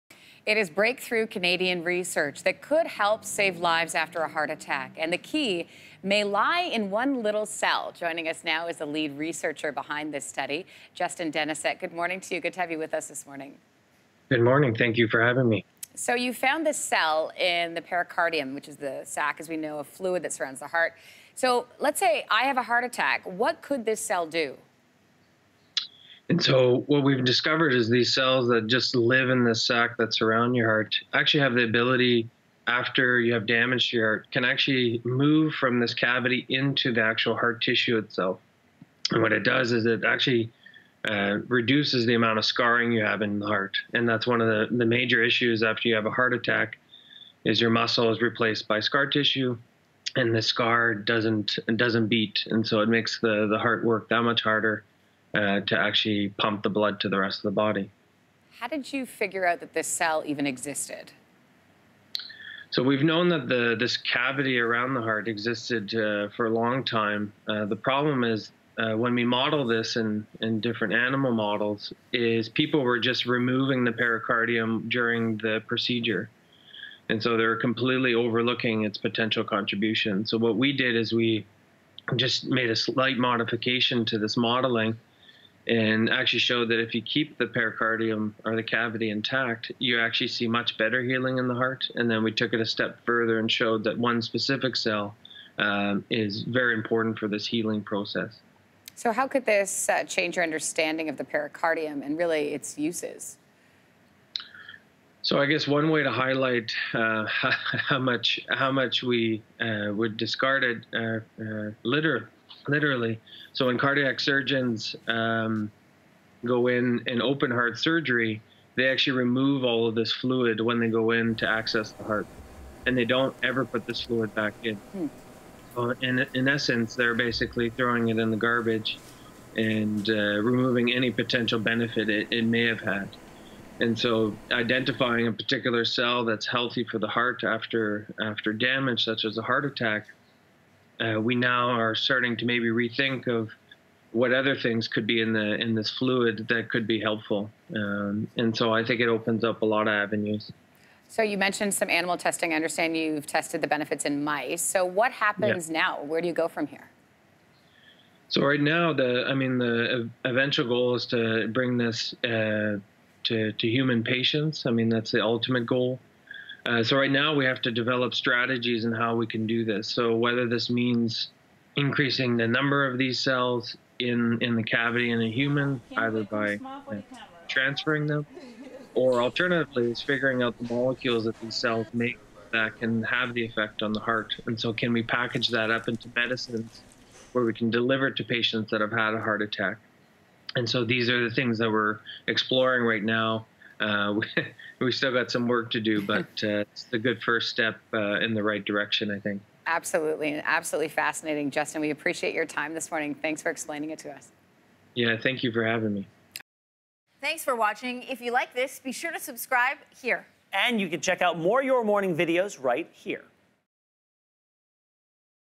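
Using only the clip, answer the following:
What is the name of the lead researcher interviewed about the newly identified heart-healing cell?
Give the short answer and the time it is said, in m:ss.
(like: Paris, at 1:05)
Justin Deniset, at 0:10.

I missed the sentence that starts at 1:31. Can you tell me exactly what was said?
And then we took it a step further and showed that one specific cell um, is very important for this healing process.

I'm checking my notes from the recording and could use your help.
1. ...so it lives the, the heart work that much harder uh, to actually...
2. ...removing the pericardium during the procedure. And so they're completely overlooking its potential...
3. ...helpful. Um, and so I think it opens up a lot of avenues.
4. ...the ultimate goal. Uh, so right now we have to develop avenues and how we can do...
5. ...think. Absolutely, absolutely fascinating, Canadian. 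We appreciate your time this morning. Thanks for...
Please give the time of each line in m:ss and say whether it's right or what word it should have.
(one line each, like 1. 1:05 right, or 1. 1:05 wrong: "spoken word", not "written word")
1. 0:52 wrong: "makes", not "lives"
2. 1:13 right
3. 2:26 right
4. 2:45 wrong: "strategies", not "avenues"
5. 3:19 wrong: "Justin", not "Canadian".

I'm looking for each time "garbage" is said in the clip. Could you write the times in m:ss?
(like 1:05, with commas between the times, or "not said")
2:08.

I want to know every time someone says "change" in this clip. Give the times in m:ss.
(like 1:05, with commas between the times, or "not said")
1:40.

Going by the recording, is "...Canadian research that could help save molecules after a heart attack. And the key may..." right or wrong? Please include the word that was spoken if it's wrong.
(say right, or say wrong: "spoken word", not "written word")
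wrong: "lives", not "molecules".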